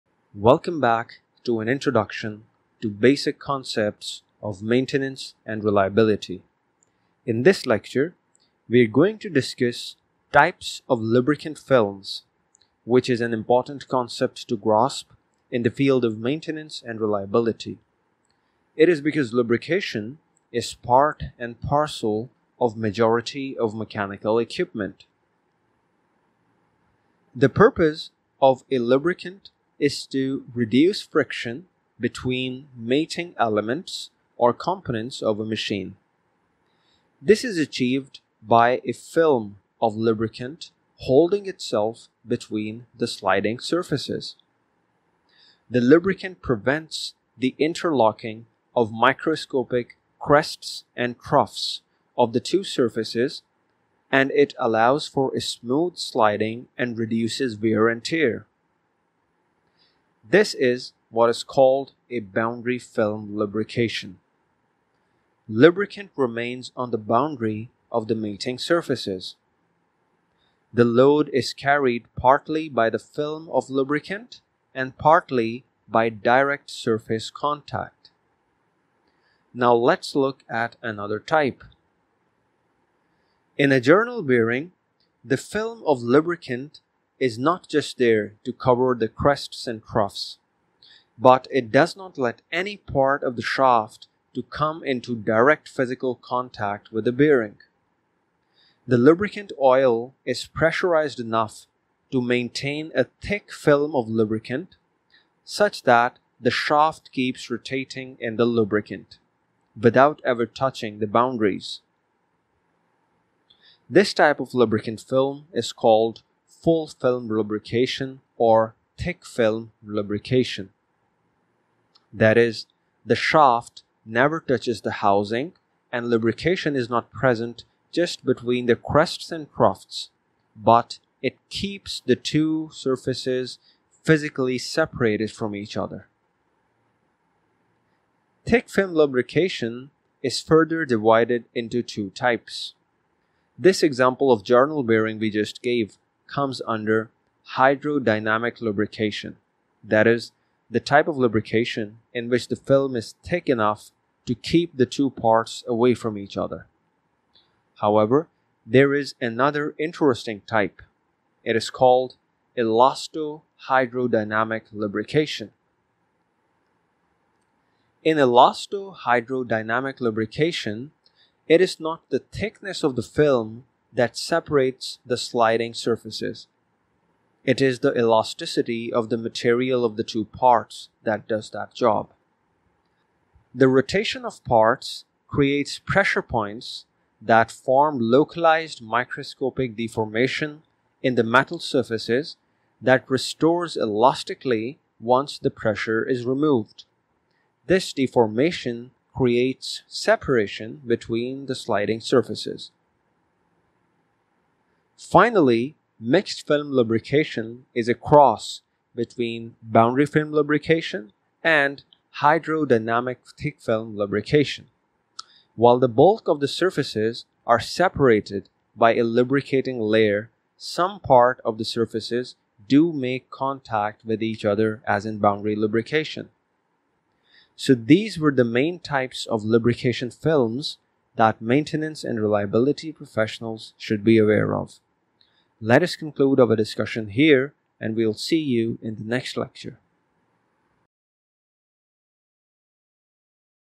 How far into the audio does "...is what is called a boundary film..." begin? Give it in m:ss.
1:00.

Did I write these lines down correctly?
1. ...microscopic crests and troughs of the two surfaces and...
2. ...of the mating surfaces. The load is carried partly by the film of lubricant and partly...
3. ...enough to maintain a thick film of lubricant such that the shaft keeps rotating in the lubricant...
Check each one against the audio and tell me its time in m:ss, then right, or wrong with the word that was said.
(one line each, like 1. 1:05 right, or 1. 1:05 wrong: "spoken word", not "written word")
1. 0:48 right
2. 1:07 right
3. 1:41 right.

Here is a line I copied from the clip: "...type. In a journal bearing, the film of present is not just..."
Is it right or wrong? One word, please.
wrong.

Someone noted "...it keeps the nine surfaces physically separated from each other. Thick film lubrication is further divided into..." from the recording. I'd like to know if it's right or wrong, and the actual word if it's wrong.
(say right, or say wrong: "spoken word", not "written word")
wrong: "two", not "nine".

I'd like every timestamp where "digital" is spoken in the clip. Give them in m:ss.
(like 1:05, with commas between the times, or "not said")
not said.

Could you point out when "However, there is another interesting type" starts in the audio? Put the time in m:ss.
2:37.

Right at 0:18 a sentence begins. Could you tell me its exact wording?
It is because lubrication is part and parcel of majority of mechanical equipment.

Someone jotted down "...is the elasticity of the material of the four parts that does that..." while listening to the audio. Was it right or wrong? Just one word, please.
wrong.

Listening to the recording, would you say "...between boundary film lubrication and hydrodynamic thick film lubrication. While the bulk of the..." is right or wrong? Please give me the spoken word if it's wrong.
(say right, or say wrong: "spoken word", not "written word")
right.